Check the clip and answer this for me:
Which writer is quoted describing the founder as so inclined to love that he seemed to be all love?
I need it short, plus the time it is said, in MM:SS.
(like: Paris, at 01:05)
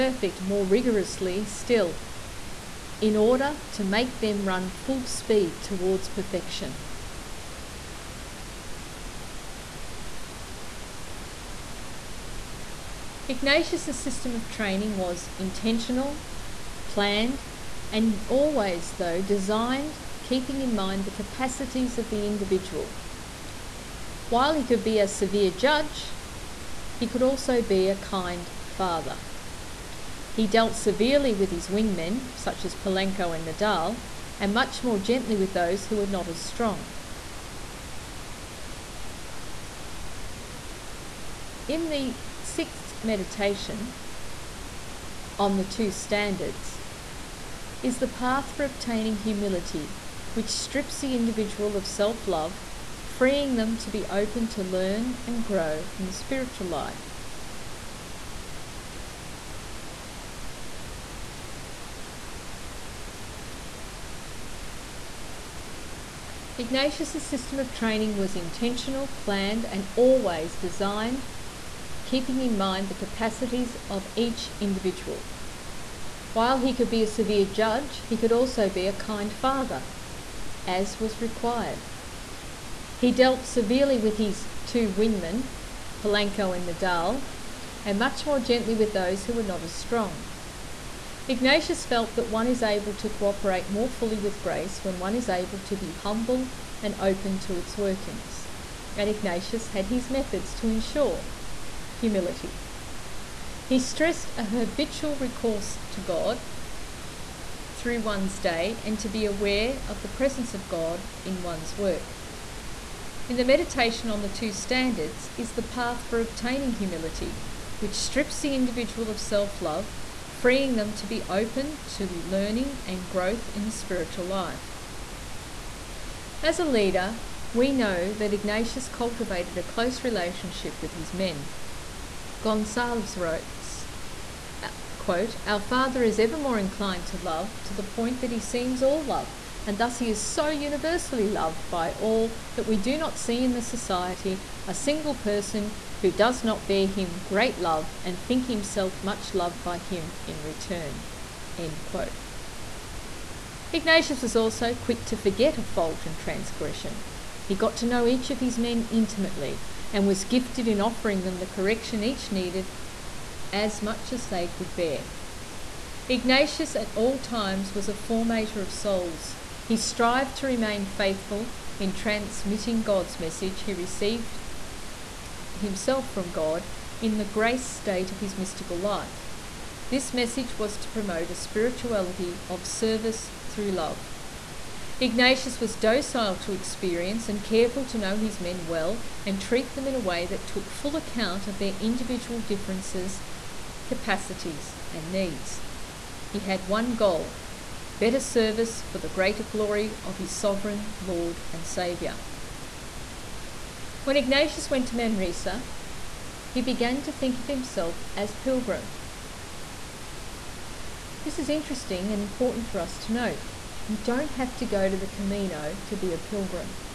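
Gonsalves, at 02:12.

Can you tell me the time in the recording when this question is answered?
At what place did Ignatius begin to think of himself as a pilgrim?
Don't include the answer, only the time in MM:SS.
03:24.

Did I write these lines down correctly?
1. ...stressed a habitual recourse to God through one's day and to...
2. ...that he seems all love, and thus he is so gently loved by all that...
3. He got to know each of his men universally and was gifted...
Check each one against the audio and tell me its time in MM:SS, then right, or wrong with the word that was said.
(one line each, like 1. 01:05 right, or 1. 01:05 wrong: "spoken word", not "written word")
1. 01:43 right
2. 02:18 wrong: "universally", not "gently"
3. 02:37 wrong: "intimately", not "universally".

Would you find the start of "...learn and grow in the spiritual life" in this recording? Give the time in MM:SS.
00:54.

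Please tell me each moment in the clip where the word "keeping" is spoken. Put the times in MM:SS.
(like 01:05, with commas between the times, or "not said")
00:20, 01:12.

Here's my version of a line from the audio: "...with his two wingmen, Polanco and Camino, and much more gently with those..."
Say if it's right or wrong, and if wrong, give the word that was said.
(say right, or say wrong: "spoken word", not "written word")
wrong: "Nadal", not "Camino".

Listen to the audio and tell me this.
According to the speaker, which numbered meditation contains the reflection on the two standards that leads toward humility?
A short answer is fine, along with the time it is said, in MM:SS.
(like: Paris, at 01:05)
sixth, at 00:42.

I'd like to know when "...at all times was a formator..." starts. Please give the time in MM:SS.
02:46.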